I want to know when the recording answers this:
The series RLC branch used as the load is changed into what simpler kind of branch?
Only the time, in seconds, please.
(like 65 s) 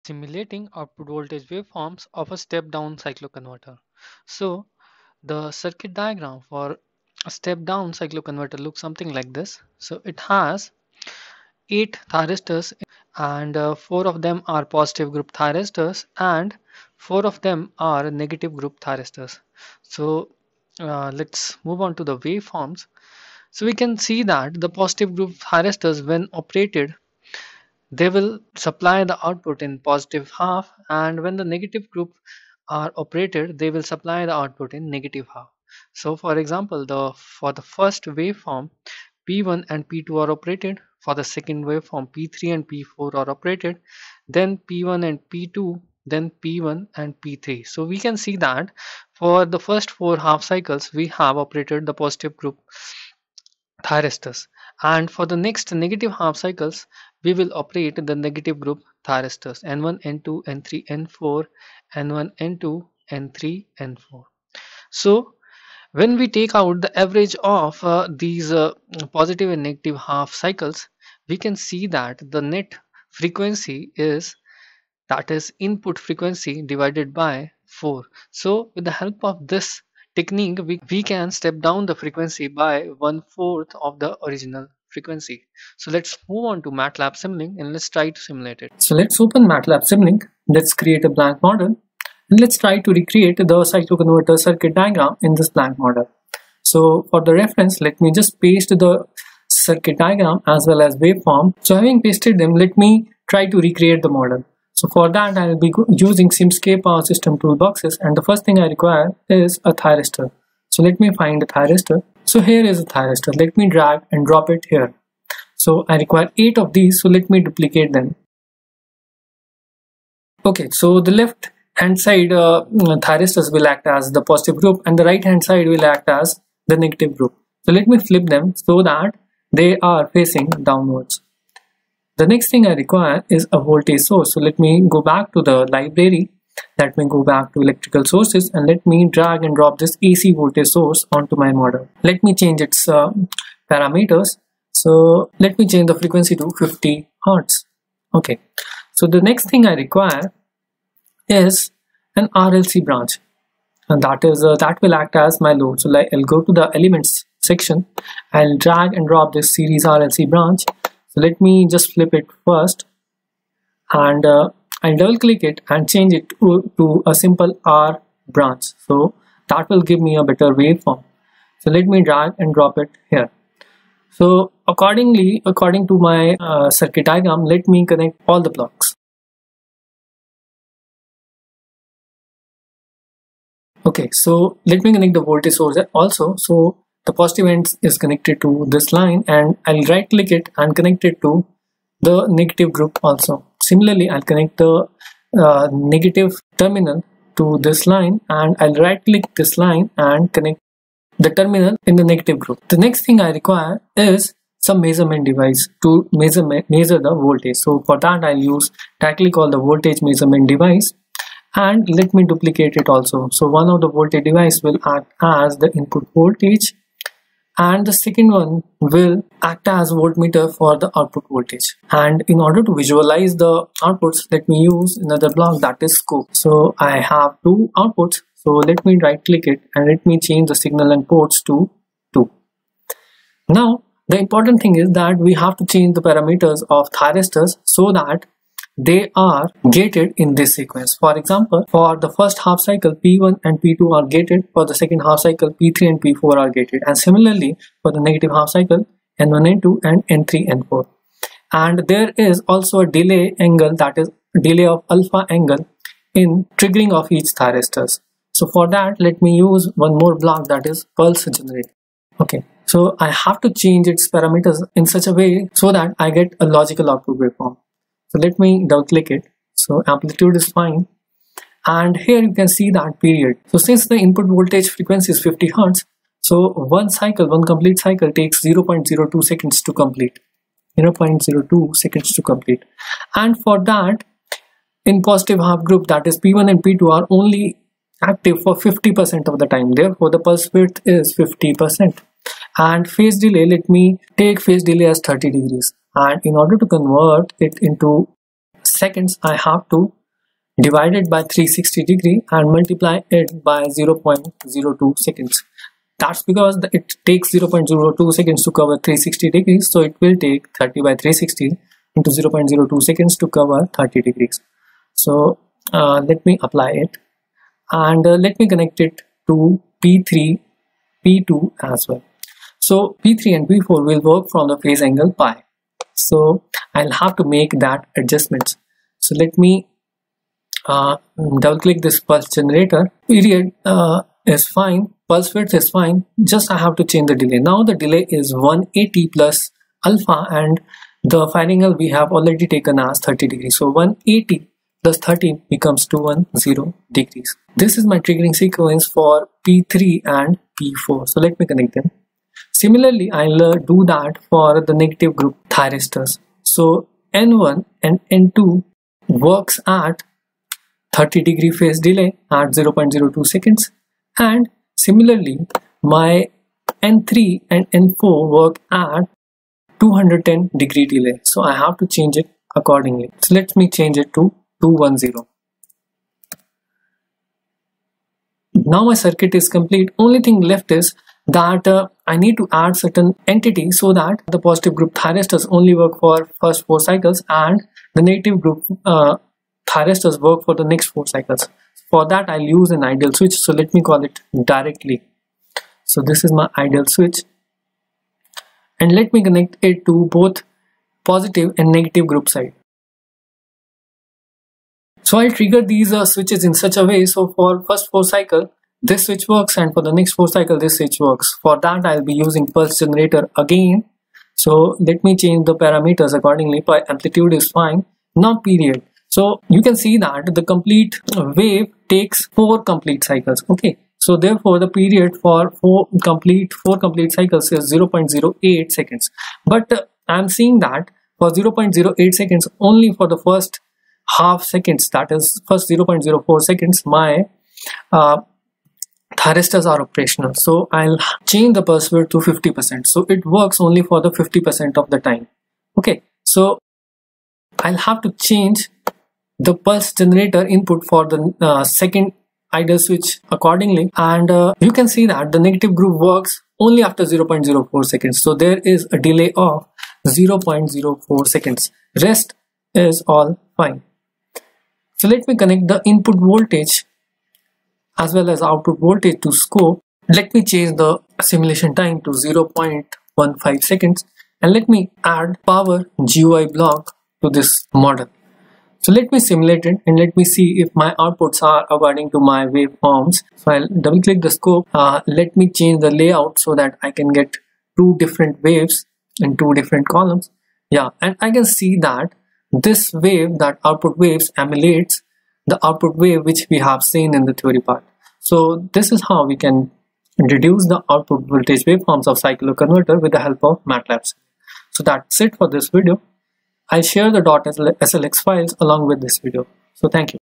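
167 s.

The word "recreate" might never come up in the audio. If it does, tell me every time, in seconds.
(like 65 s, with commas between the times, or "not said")
92 s, 103 s.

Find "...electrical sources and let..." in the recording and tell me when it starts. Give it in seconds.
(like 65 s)
137 s.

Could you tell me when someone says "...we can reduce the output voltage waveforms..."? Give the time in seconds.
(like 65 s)
499 s.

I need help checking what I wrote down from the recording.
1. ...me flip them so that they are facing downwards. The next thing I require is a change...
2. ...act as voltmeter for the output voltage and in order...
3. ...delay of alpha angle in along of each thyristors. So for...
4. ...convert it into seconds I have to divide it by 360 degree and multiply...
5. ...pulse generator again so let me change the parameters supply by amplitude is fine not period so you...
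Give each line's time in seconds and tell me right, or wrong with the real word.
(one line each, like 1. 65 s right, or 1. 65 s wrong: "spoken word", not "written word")
1. 127 s wrong: "voltage", not "change"
2. 219 s right
3. 254 s wrong: "triggering", not "along"
4. 296 s right
5. 412 s wrong: "accordingly", not "supply".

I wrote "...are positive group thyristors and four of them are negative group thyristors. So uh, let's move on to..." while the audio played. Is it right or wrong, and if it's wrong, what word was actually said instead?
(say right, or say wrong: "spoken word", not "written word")
right.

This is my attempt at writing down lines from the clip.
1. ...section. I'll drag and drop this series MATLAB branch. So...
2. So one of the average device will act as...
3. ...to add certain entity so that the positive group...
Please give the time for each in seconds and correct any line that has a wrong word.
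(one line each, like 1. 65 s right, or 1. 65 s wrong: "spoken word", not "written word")
1. 157 s wrong: "RLC", not "MATLAB"
2. 213 s wrong: "voltage", not "average"
3. 382 s right.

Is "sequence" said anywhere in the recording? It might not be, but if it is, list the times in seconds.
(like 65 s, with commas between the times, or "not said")
240 s, 348 s.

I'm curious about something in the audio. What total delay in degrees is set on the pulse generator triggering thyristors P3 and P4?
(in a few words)
210 degrees.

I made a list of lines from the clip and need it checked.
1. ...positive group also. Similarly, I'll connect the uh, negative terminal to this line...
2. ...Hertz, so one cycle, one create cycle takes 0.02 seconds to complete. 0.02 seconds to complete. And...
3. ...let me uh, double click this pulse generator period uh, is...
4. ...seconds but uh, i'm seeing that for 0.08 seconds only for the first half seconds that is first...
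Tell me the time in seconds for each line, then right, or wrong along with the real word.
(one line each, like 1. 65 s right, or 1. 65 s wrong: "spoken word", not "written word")
1. 192 s wrong: "negative", not "positive"
2. 275 s wrong: "complete", not "create"
3. 329 s right
4. 428 s right.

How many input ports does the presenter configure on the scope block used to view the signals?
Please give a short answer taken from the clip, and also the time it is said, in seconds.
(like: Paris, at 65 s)
2, at 232 s.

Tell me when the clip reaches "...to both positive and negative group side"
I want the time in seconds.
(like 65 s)
399 s.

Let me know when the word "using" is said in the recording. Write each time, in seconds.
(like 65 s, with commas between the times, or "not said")
105 s, 412 s.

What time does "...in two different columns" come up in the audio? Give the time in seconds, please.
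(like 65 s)
489 s.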